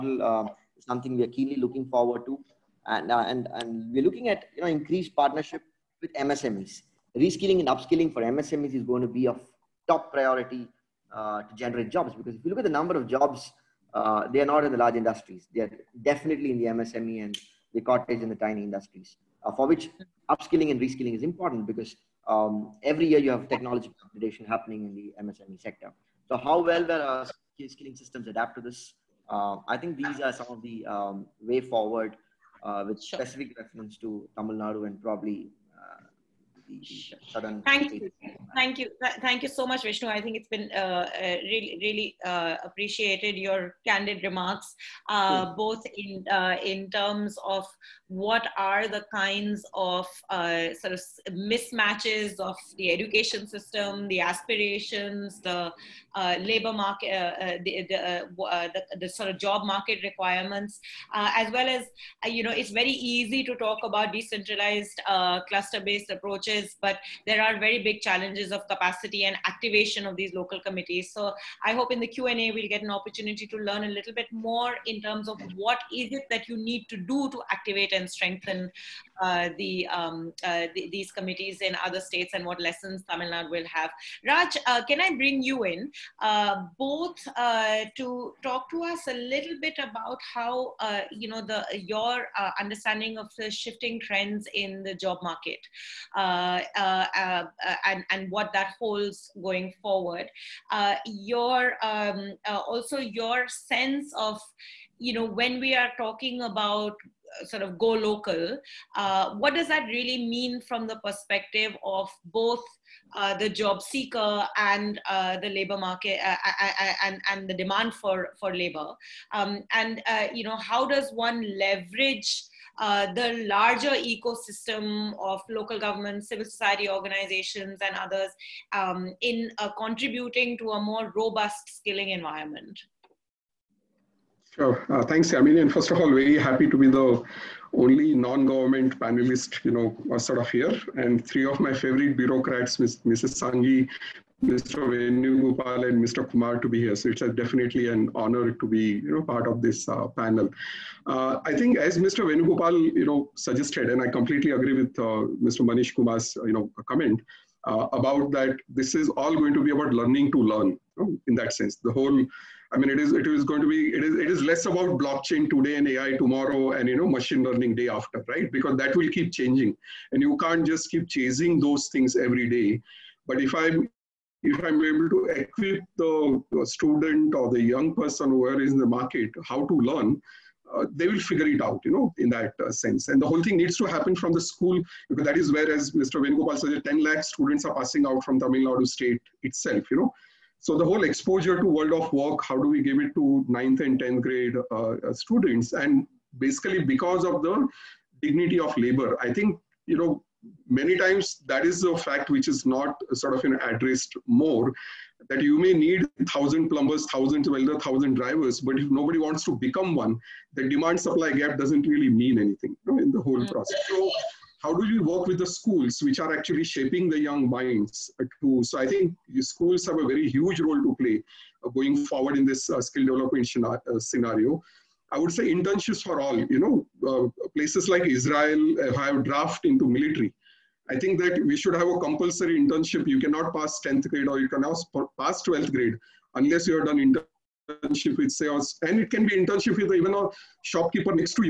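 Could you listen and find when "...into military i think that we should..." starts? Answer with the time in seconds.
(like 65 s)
229 s.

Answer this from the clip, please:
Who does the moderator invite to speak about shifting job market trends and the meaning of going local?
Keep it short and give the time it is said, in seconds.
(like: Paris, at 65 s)
Raj, at 84 s.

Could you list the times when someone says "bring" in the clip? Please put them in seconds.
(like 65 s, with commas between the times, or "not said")
85 s.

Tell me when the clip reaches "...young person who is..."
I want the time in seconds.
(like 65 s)
177 s.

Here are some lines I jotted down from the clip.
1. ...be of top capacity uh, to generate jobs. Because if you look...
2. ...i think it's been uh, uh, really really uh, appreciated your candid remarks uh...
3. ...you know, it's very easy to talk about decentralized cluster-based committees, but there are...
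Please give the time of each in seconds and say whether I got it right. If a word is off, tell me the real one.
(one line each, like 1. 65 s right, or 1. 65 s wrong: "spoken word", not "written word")
1. 9 s wrong: "priority", not "capacity"
2. 40 s right
3. 62 s wrong: "approaches", not "committees".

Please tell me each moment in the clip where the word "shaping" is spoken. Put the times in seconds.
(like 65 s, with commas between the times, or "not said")
216 s.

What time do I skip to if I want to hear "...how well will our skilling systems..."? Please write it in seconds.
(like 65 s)
26 s.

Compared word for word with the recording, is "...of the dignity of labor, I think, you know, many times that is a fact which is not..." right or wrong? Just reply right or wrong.
right.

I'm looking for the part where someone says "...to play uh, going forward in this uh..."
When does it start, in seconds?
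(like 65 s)
220 s.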